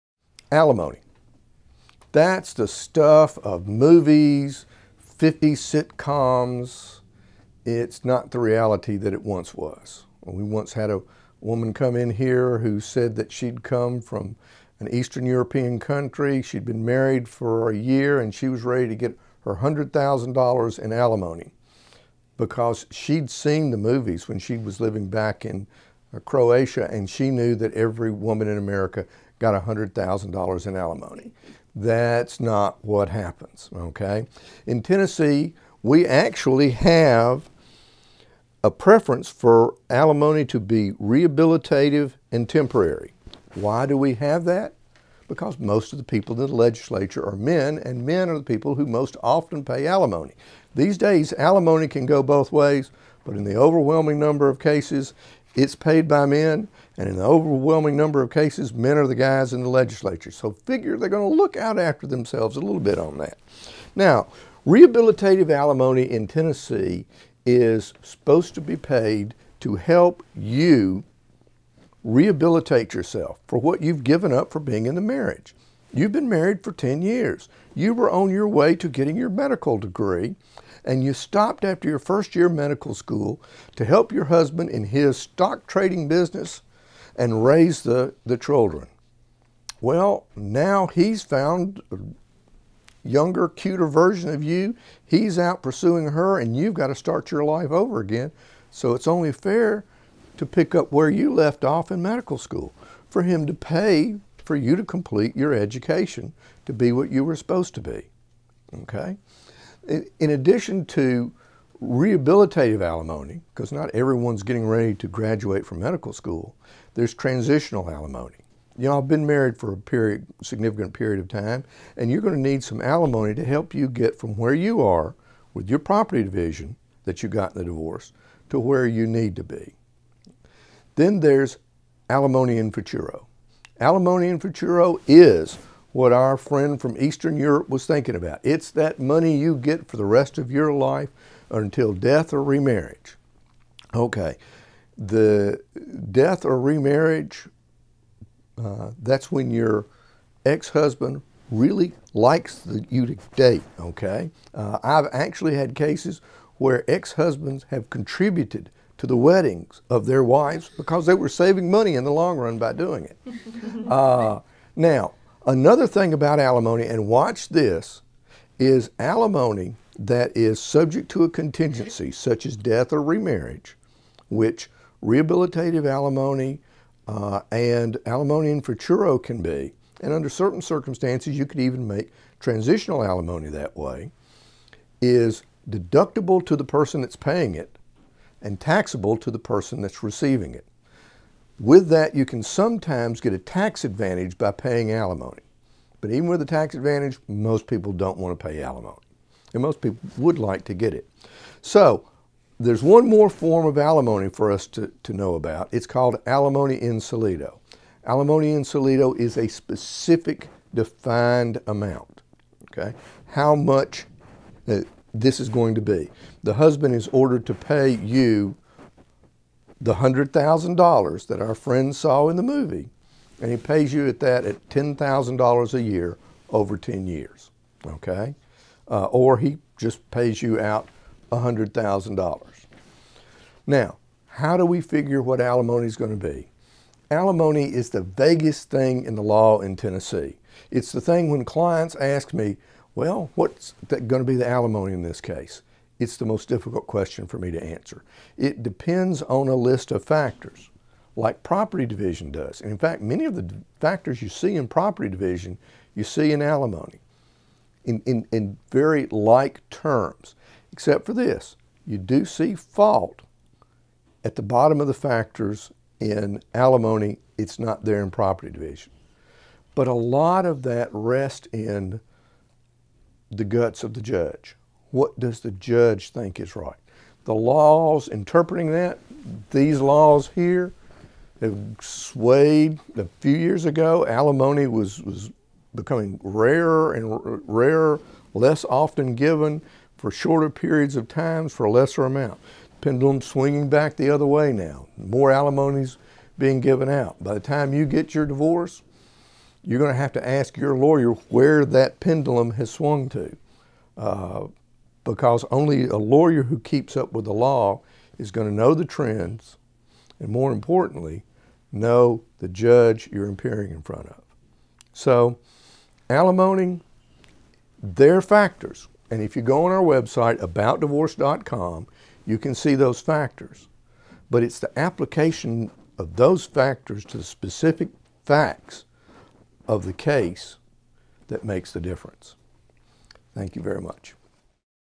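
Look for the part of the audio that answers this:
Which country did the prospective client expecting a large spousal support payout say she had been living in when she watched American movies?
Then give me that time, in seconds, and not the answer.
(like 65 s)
26 s.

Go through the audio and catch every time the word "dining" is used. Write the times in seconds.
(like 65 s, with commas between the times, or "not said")
not said.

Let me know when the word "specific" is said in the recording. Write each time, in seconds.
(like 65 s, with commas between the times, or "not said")
209 s, 327 s.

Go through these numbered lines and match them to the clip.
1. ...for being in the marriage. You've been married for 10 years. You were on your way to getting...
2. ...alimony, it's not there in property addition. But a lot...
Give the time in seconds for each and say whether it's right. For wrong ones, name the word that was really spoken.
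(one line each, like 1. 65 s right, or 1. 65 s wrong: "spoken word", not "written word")
1. 74 s right
2. 266 s wrong: "division", not "addition".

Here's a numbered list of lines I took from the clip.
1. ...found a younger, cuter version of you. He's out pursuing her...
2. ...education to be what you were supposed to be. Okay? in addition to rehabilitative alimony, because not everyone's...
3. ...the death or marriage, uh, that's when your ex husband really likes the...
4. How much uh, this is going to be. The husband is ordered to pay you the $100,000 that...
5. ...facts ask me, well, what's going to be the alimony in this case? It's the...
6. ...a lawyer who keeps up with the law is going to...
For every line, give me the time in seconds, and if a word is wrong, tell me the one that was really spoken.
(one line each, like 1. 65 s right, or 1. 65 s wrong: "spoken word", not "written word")
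1. 91 s right
2. 105 s right
3. 144 s wrong: "remarriage", not "marriage"
4. 213 s right
5. 241 s wrong: "clients", not "facts"
6. 305 s right.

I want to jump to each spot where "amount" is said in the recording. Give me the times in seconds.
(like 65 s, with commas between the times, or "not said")
211 s, 292 s.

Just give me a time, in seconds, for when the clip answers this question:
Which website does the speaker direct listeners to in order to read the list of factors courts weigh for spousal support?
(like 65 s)
320 s.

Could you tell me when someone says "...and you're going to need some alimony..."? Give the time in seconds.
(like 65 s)
121 s.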